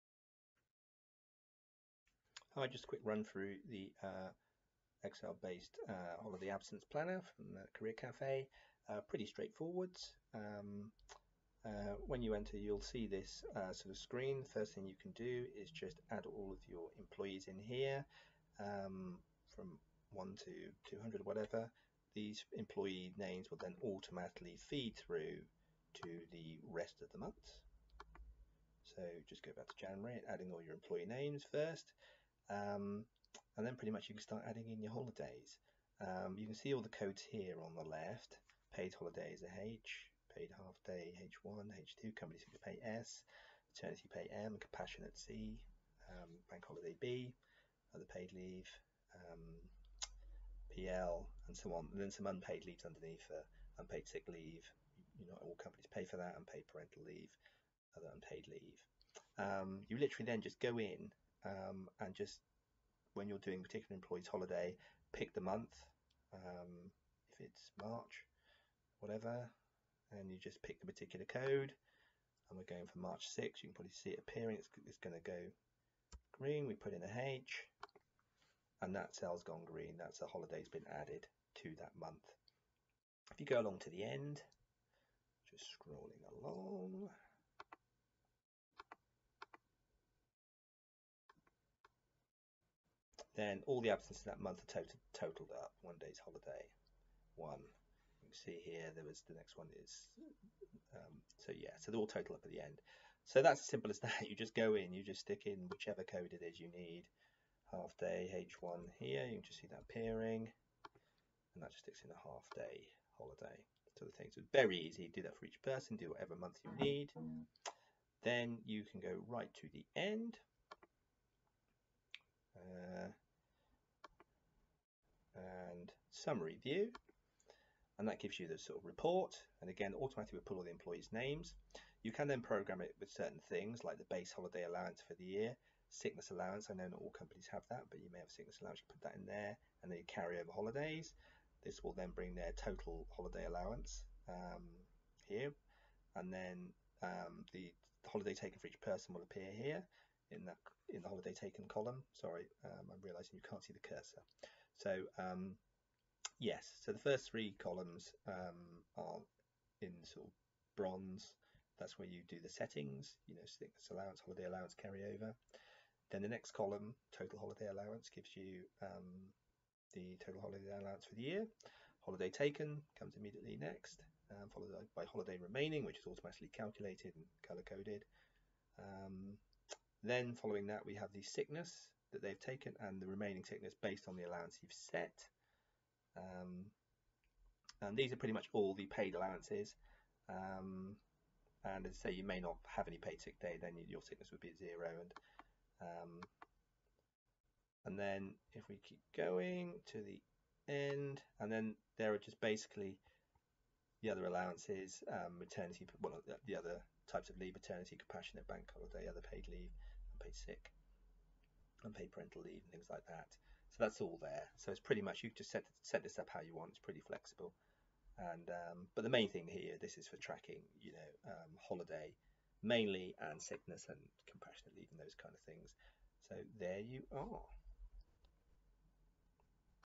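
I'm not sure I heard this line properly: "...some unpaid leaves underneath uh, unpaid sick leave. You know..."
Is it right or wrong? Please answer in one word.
right.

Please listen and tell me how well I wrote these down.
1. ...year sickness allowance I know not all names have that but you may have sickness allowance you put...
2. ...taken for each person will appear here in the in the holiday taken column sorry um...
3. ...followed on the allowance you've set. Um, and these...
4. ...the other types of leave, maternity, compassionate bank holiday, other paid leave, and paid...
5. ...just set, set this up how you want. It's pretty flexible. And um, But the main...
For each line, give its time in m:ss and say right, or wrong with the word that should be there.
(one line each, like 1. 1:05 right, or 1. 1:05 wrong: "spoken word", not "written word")
1. 2:15 wrong: "companies", not "names"
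2. 2:28 right
3. 3:03 wrong: "based", not "followed"
4. 3:26 right
5. 3:35 right.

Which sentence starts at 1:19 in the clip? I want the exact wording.
That's a holiday's been added to that month.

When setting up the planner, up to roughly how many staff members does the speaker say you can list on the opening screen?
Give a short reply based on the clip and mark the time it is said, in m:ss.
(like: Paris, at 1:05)
200, at 0:20.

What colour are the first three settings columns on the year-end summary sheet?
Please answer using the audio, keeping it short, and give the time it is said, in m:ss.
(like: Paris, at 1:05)
bronze, at 2:40.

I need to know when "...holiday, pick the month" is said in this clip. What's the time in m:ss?
1:04.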